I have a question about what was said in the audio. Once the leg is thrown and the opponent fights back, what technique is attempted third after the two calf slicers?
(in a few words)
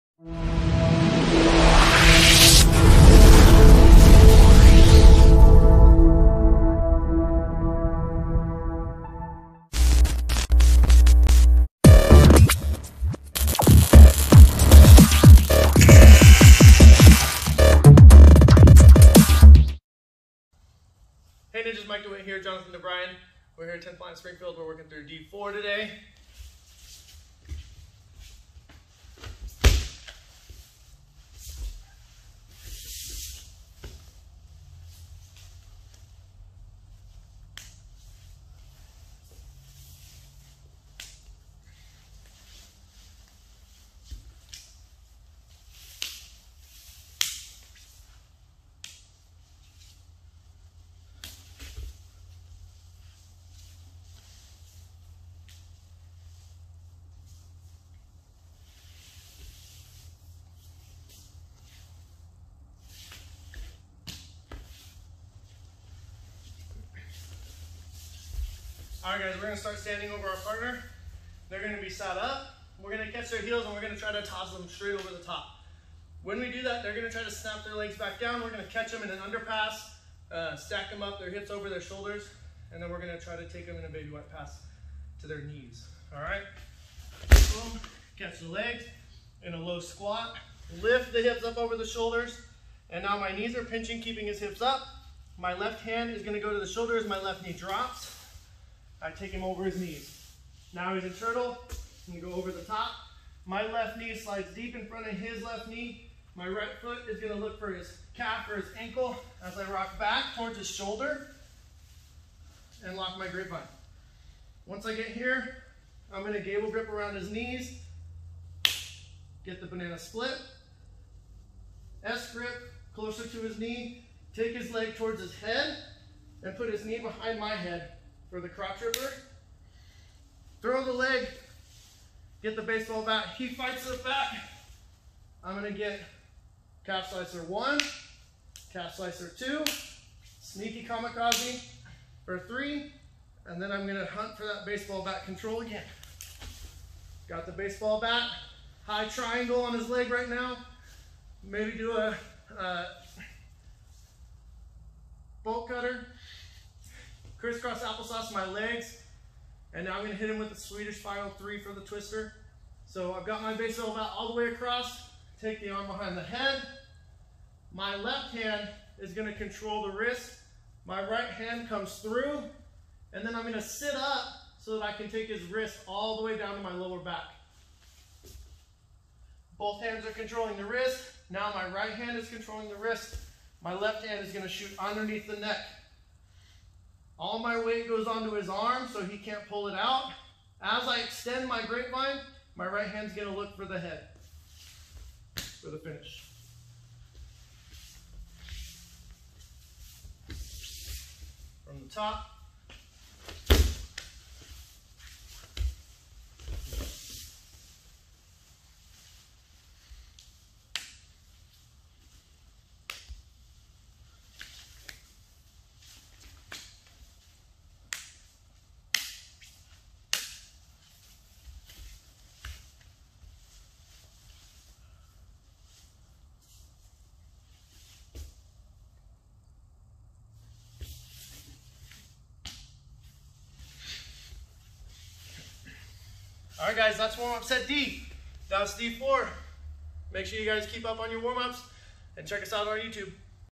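sneaky kamikaze.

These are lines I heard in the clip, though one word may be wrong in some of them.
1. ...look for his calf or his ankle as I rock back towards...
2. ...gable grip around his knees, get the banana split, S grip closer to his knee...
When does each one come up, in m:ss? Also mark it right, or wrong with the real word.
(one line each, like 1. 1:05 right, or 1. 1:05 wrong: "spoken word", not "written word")
1. 1:47 right
2. 1:56 right.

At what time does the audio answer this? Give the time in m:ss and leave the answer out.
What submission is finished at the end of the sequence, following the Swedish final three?
2:41.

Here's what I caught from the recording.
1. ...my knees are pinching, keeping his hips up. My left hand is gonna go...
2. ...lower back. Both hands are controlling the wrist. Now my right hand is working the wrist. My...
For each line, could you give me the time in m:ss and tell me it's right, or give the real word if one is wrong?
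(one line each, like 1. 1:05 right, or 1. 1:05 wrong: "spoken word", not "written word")
1. 1:33 right
2. 2:56 wrong: "controlling", not "working".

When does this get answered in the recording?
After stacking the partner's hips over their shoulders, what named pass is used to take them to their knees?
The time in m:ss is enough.
1:23.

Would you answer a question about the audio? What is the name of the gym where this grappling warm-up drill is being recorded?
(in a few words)
10th Planet Springfield.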